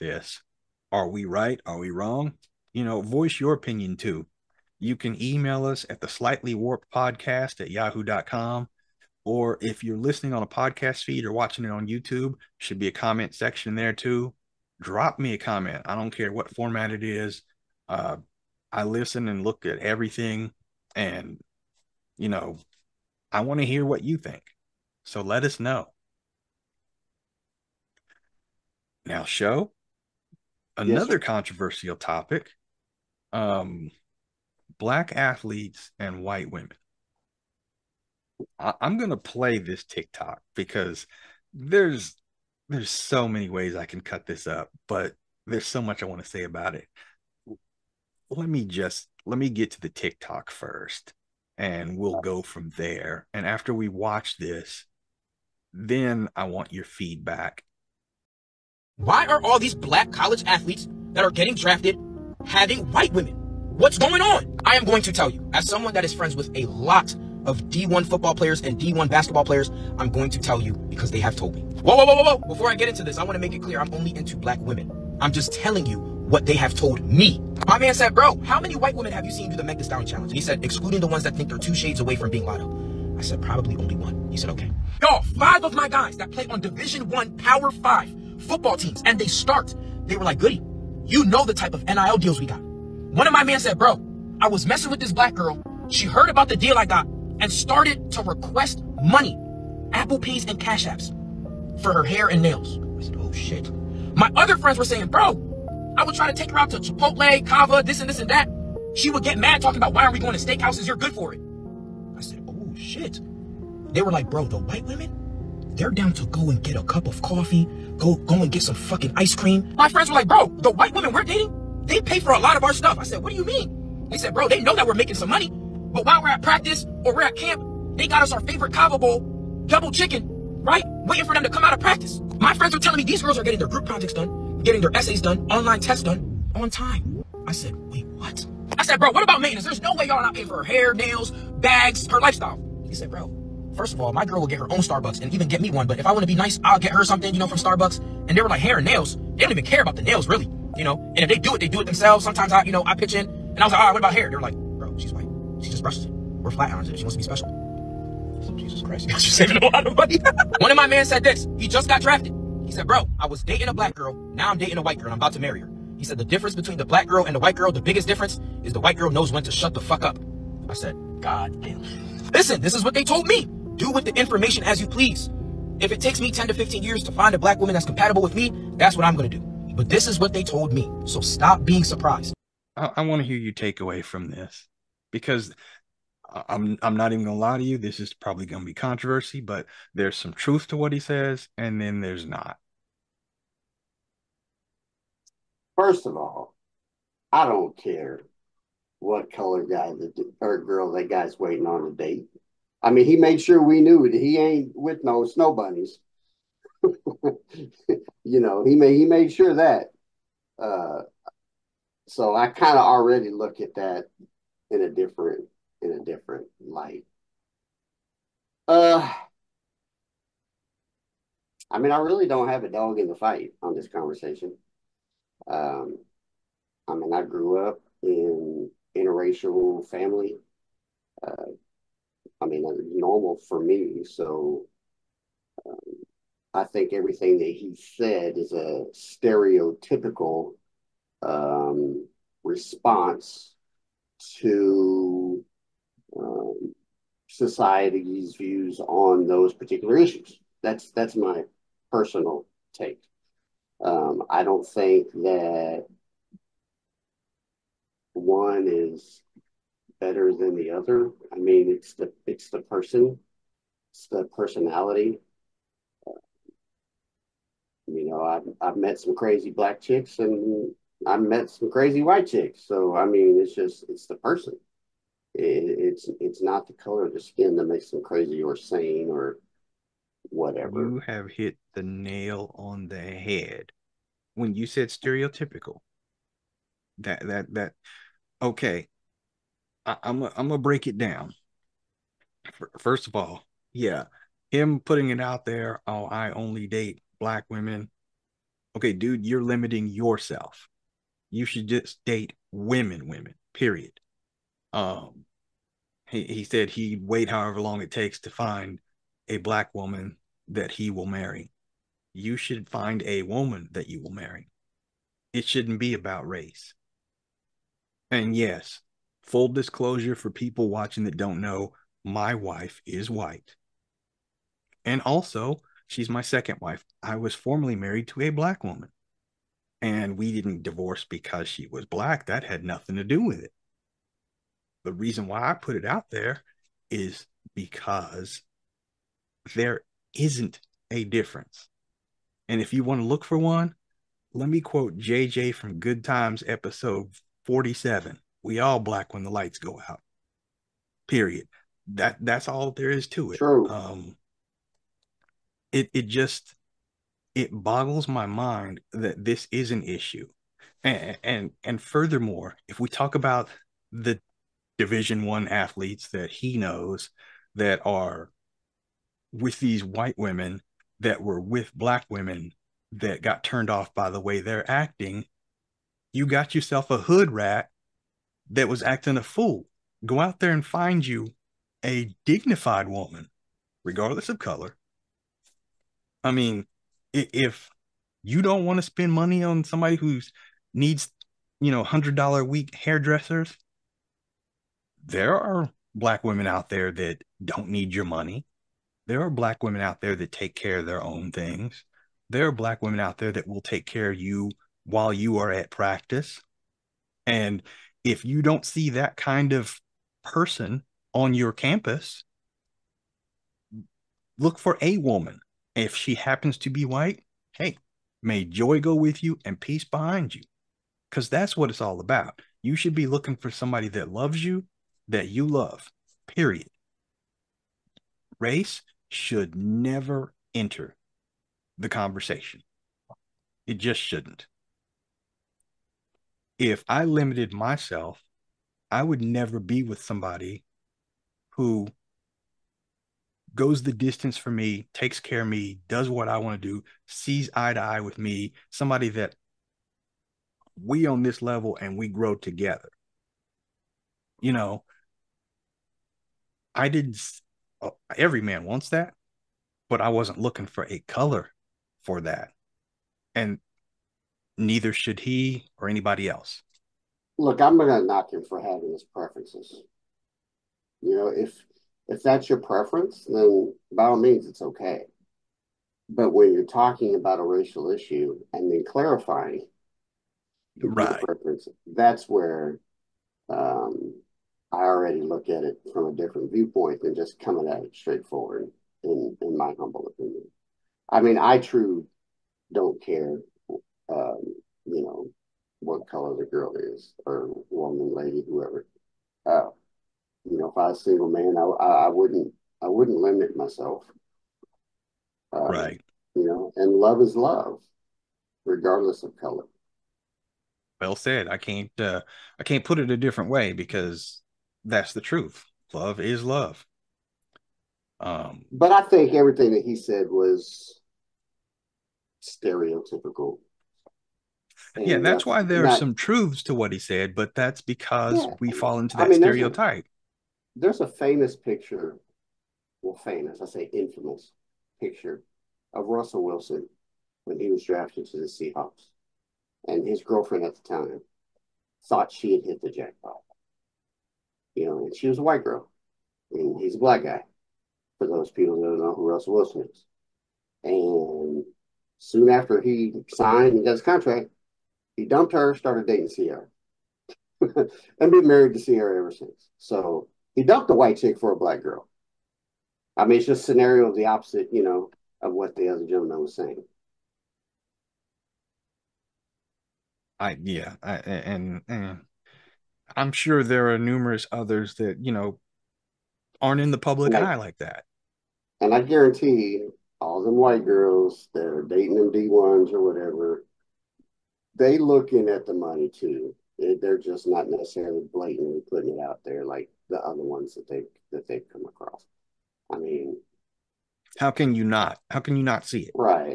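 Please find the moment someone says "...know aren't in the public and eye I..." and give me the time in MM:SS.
09:35.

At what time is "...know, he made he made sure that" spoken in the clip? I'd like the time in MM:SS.
03:28.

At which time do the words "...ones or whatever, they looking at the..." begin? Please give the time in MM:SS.
09:42.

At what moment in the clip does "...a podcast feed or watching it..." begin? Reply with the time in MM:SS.
00:10.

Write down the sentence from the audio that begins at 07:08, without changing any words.
Race should never enter the conversation.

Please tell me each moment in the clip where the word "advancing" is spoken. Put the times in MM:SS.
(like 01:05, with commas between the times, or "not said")
not said.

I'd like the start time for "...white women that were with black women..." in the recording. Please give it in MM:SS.
06:09.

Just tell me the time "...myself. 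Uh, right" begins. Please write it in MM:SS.
08:23.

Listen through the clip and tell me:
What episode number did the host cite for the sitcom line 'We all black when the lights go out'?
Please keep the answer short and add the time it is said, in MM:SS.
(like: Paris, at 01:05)
47, at 05:46.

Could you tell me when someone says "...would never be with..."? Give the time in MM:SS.
07:19.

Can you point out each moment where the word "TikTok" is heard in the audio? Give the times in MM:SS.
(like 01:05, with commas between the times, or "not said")
00:39, 00:49.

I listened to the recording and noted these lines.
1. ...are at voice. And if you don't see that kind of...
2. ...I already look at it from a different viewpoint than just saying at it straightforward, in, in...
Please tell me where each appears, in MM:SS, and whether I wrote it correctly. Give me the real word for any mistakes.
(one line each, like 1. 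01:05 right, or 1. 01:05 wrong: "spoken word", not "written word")
1. 06:45 wrong: "practice", not "voice"
2. 08:04 wrong: "coming", not "saying".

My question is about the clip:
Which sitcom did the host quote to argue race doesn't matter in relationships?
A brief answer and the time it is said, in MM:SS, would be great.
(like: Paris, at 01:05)
Good Times, at 05:45.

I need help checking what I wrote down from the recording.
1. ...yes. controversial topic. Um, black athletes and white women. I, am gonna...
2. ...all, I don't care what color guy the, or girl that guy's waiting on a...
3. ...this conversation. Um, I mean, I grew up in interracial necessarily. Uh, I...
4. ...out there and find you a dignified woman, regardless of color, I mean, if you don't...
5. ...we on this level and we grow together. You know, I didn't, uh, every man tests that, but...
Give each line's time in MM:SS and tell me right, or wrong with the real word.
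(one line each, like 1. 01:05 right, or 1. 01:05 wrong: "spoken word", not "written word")
1. 00:31 right
2. 03:16 right
3. 03:43 wrong: "family", not "necessarily"
4. 06:20 right
5. 07:30 wrong: "wants", not "tests".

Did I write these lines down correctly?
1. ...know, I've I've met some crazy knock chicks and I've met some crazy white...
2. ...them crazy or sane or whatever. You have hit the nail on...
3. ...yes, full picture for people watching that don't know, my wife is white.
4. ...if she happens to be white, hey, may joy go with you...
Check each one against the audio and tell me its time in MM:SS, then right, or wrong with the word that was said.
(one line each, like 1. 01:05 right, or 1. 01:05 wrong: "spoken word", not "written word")
1. 04:28 wrong: "black", not "knock"
2. 04:37 right
3. 05:18 wrong: "disclosure", not "picture"
4. 06:55 right.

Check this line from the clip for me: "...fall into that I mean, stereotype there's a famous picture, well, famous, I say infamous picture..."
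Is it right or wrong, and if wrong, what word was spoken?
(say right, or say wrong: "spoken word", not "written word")
right.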